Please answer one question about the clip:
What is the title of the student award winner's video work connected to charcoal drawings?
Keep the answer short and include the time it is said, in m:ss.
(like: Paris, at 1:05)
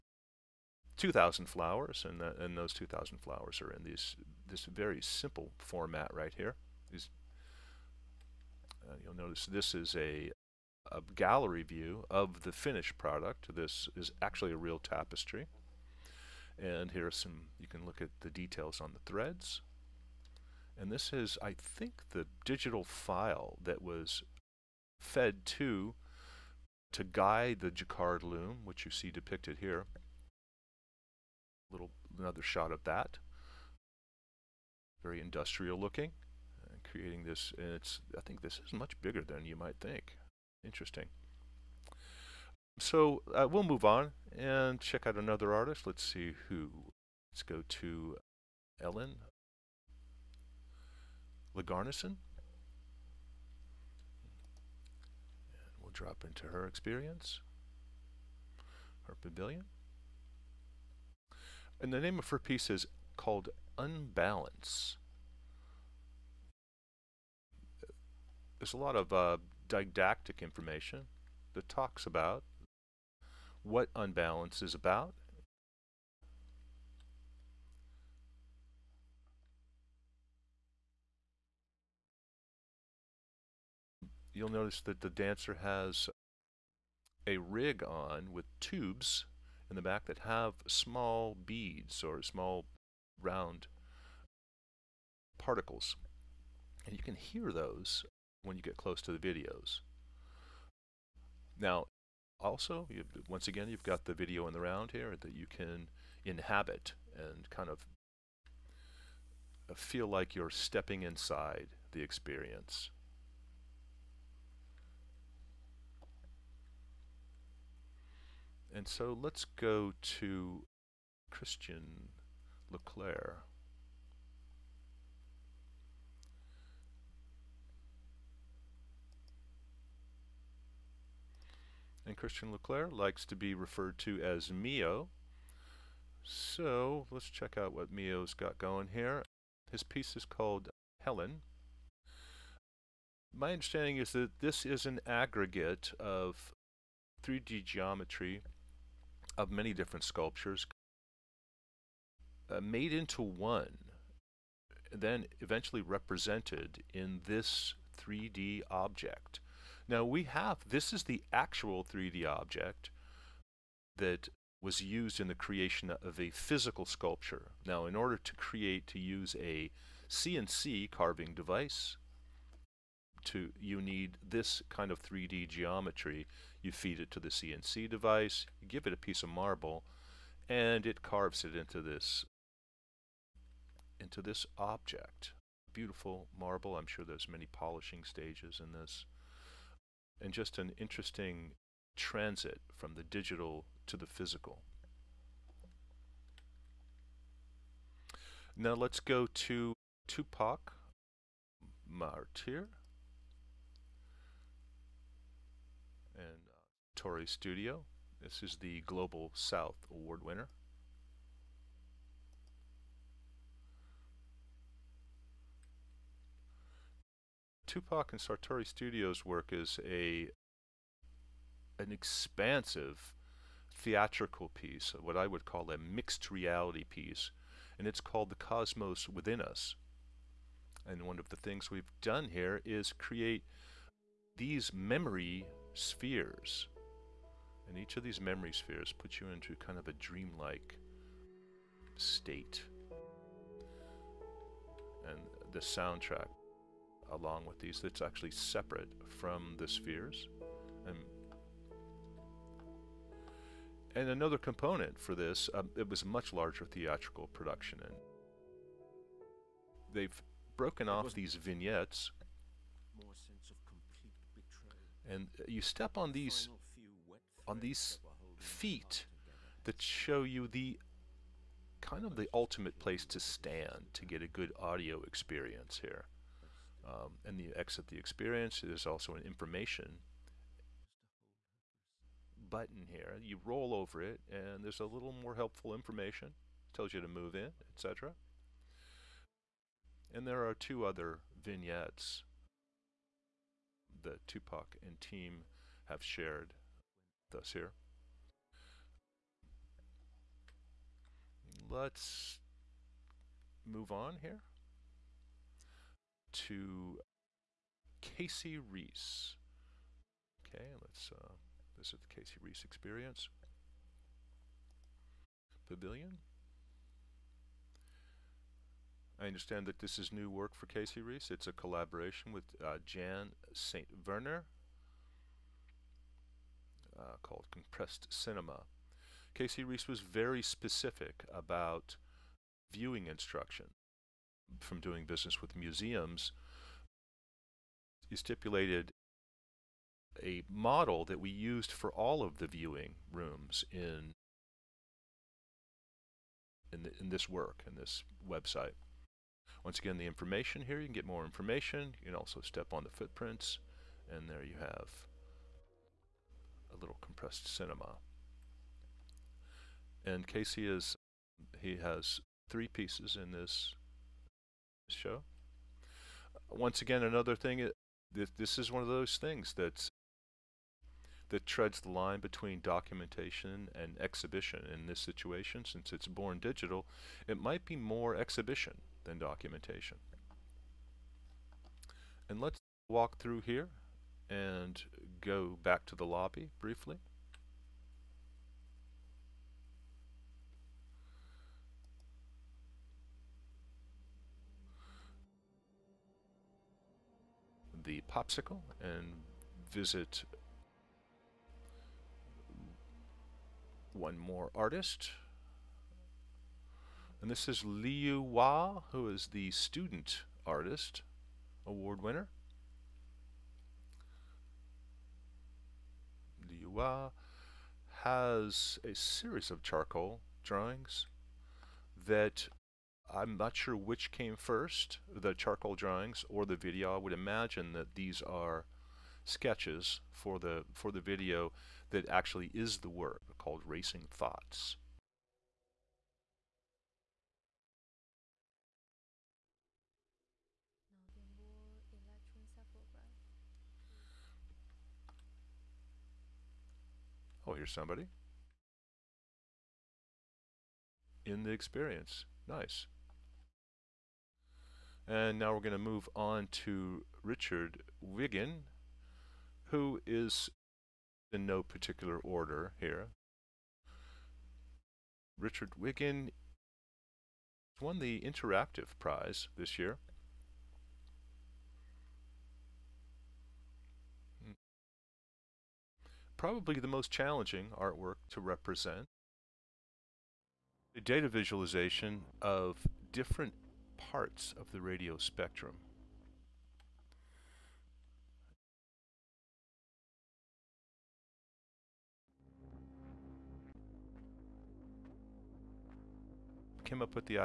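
Racing Thoughts, at 7:13.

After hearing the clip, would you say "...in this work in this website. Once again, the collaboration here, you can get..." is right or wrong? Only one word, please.
wrong.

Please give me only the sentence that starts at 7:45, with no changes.
Richard Wiggin won the Interactive Prize this year.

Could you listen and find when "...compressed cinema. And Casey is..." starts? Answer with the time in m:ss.
5:57.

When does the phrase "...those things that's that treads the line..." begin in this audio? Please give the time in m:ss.
6:08.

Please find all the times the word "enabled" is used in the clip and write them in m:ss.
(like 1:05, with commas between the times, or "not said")
not said.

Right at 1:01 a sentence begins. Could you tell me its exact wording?
And the name of her piece is called Unbalance.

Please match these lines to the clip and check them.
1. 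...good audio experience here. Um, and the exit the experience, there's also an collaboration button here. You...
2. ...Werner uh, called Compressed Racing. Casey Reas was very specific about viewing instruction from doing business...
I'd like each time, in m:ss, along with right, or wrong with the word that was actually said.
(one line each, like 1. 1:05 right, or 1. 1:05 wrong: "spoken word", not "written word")
1. 4:34 wrong: "information", not "collaboration"
2. 5:24 wrong: "Cinema", not "Racing".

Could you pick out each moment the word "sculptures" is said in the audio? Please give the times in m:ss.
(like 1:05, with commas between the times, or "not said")
2:30, 2:46.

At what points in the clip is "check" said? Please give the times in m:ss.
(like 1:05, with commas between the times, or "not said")
0:44, 2:17.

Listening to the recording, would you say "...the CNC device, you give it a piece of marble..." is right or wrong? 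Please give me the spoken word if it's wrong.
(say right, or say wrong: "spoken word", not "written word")
right.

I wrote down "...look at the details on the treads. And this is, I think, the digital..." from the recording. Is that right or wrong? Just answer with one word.
wrong.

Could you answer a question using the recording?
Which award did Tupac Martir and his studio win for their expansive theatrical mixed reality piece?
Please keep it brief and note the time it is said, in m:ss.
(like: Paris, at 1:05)
Global South Award, at 3:28.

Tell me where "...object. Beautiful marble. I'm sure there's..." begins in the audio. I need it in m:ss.
3:04.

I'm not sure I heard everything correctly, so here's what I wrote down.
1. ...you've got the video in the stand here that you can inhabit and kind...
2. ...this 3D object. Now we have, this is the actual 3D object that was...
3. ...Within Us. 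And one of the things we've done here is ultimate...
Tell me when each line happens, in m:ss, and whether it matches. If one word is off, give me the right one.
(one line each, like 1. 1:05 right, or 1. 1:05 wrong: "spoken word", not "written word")
1. 1:43 wrong: "round", not "stand"
2. 2:37 right
3. 3:49 wrong: "create", not "ultimate".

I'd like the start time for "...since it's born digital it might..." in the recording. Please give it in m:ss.
6:15.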